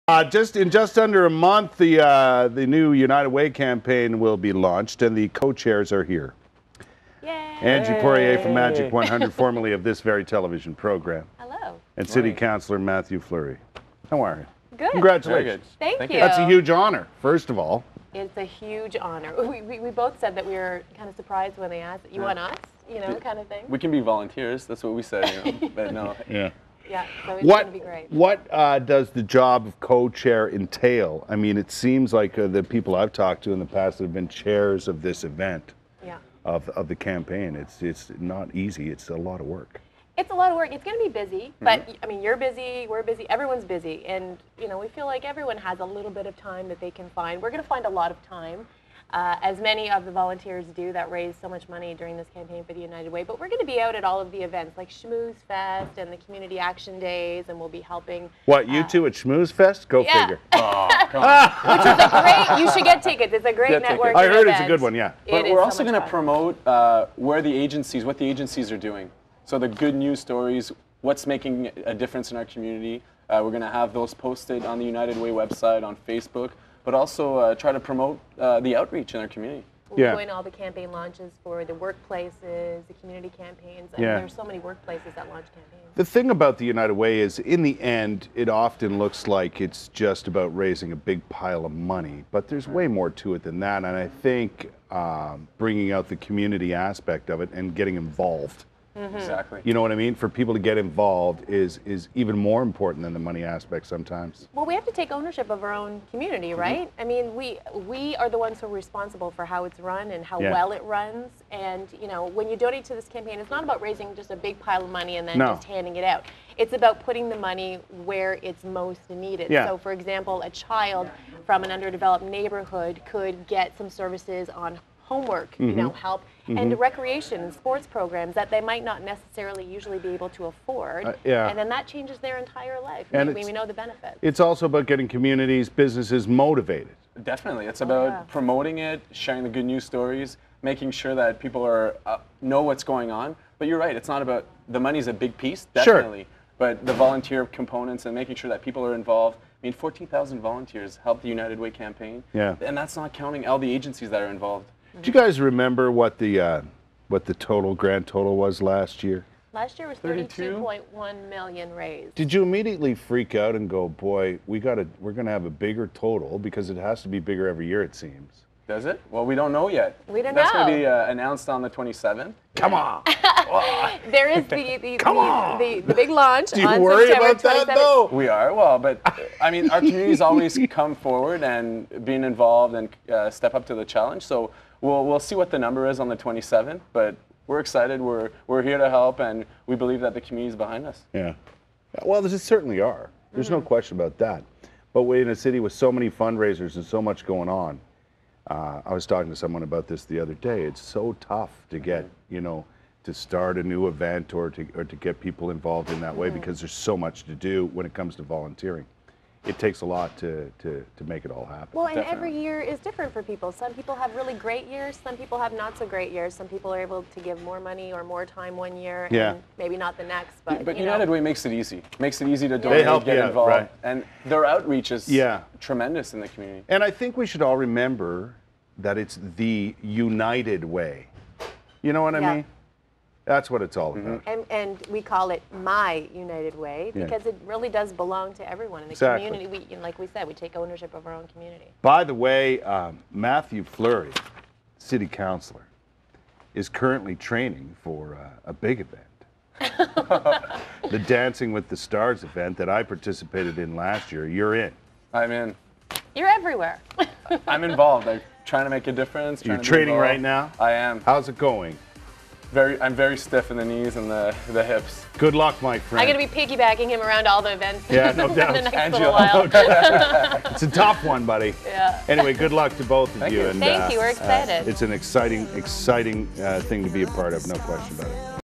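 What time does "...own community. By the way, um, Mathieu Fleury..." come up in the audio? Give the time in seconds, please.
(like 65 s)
241 s.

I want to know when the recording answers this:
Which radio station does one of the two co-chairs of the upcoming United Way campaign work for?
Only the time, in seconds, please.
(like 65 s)
8 s.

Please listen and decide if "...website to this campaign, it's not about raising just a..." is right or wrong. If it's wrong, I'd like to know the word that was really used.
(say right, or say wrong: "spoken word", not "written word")
wrong: "donate", not "website".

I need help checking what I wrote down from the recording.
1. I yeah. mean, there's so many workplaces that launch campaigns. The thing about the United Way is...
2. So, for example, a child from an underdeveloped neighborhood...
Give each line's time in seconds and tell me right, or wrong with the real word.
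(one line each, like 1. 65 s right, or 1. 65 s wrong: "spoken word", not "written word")
1. 83 s right
2. 119 s right.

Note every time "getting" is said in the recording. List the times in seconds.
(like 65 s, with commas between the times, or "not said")
97 s, 134 s.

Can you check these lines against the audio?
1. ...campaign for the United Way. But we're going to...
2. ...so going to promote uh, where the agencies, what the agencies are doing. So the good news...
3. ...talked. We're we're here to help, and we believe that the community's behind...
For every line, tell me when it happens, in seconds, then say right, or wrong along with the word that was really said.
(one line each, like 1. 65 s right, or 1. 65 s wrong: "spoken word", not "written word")
1. 52 s right
2. 65 s right
3. 187 s wrong: "excited", not "talked".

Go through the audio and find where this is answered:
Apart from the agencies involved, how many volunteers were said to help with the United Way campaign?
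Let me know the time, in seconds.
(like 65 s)
149 s.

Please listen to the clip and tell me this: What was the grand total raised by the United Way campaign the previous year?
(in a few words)
$32.1 million.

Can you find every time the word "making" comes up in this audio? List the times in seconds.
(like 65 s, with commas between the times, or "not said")
71 s, 140 s, 148 s.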